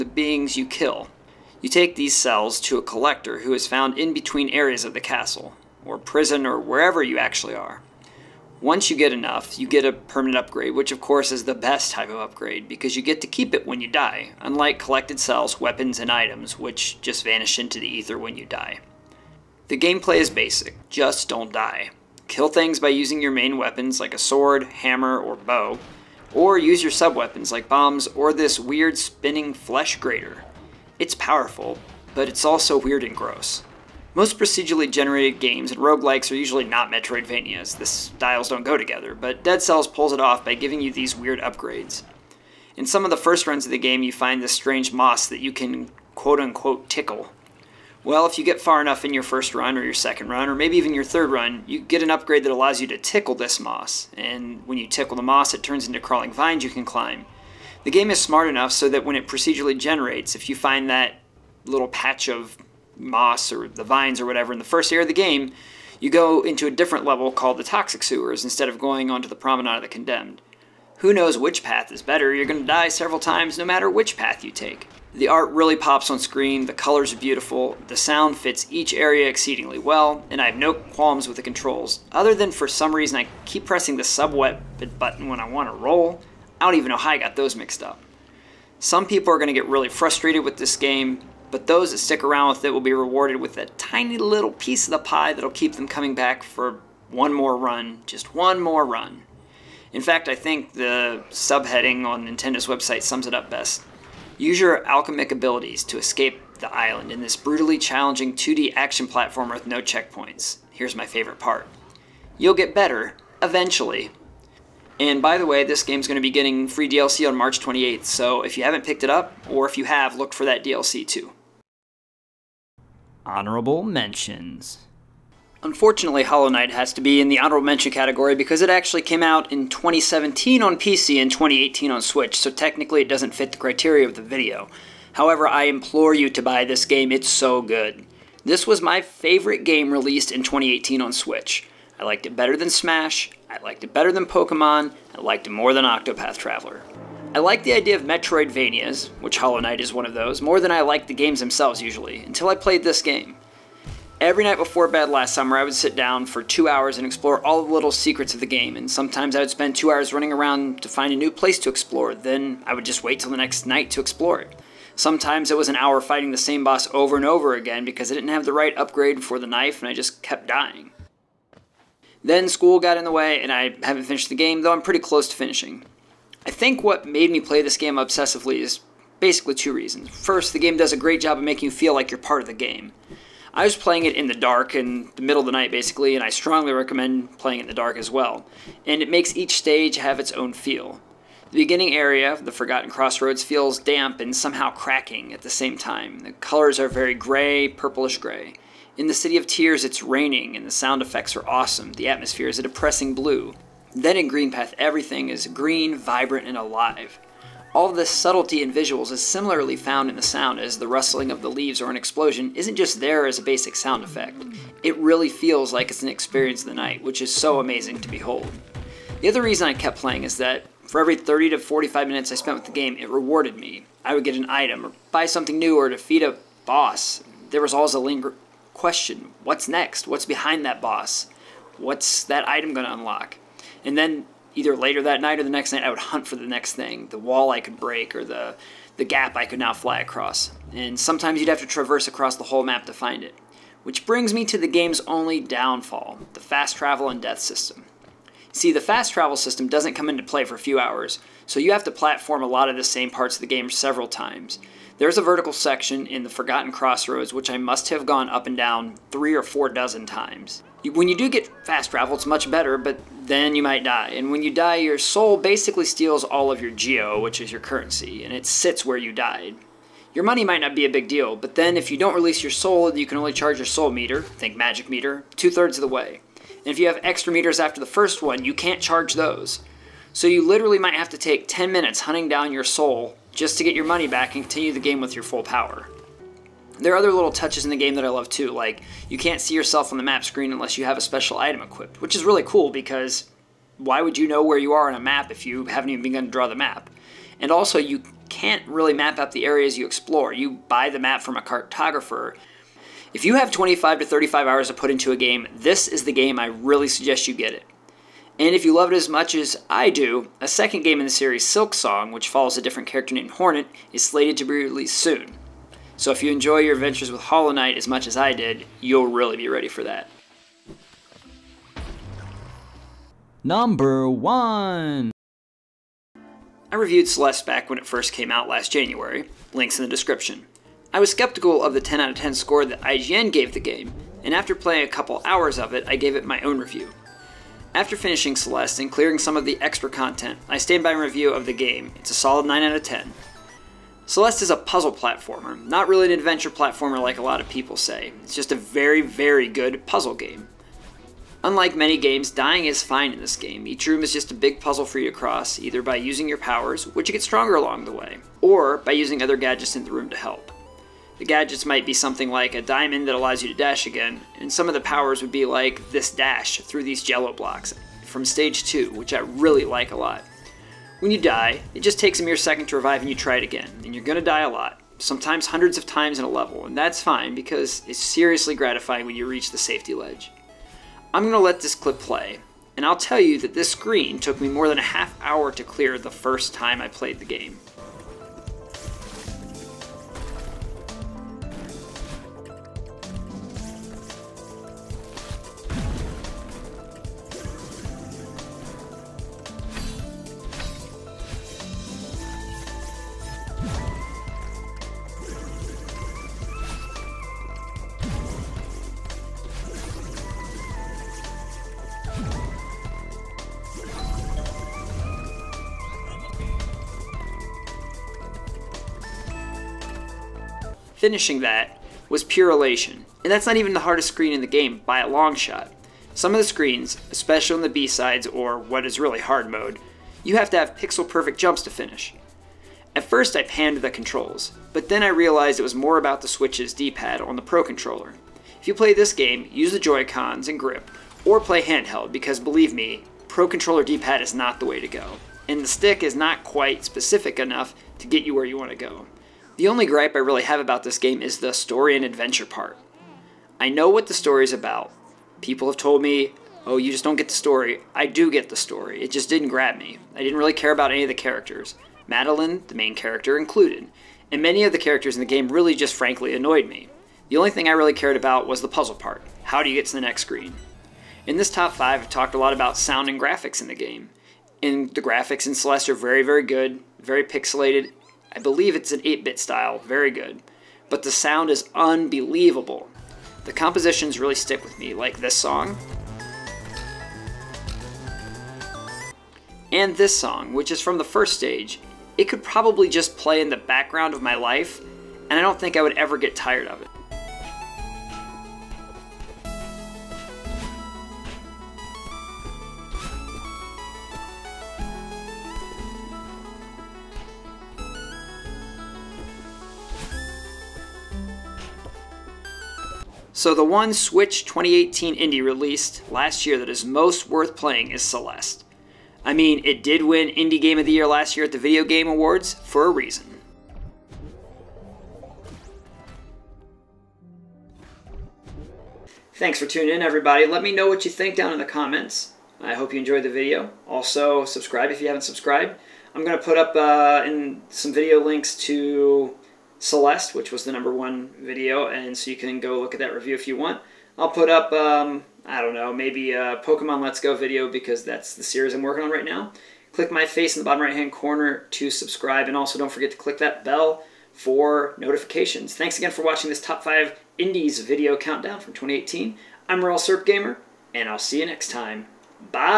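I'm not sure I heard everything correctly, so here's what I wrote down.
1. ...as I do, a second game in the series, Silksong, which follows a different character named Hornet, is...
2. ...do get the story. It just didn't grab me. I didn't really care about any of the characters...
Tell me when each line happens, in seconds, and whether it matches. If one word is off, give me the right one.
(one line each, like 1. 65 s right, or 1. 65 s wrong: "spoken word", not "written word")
1. 309 s right
2. 458 s right.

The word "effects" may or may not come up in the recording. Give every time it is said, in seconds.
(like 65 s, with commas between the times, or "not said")
201 s, 214 s.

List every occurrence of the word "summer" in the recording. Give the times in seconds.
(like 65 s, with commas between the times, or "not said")
155 s.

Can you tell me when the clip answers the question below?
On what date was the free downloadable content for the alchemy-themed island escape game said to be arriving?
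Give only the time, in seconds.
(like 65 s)
117 s.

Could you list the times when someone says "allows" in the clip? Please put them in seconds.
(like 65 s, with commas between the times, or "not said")
52 s, 363 s.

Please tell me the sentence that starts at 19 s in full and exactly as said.
The gameplay is basic, just don't die.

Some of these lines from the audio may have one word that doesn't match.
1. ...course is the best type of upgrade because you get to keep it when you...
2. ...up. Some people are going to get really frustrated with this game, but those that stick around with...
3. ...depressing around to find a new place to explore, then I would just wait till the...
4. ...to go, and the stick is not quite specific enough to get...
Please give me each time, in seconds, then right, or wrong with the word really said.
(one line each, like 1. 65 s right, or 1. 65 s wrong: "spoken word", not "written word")
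1. 11 s right
2. 87 s right
3. 160 s wrong: "running", not "depressing"
4. 444 s right.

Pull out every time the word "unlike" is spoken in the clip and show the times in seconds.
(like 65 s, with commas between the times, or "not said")
14 s, 351 s.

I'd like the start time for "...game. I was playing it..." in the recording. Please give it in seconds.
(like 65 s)
182 s.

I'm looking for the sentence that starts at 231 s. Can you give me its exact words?
What's that item going to unlock?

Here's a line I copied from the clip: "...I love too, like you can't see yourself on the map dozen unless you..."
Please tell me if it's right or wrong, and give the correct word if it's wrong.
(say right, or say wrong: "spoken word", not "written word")
wrong: "screen", not "dozen".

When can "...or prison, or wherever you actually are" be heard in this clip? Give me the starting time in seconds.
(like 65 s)
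5 s.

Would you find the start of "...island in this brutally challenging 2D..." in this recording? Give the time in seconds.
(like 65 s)
106 s.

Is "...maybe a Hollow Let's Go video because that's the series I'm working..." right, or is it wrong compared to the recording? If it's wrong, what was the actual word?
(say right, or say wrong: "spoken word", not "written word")
wrong: "Pokemon", not "Hollow".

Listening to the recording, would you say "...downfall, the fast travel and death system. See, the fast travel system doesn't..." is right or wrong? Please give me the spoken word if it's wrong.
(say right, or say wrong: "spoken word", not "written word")
right.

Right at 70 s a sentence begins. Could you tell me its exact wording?
Who knows which path is better?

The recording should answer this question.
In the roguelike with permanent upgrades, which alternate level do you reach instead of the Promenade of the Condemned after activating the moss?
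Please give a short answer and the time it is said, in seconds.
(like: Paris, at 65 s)
Toxic Sewers, at 67 s.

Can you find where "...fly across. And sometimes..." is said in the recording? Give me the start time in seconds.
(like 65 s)
239 s.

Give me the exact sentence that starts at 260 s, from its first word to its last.
When you do get fast travel, it's much better, but then you might die.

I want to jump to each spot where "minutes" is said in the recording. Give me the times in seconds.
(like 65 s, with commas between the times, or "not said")
222 s, 281 s.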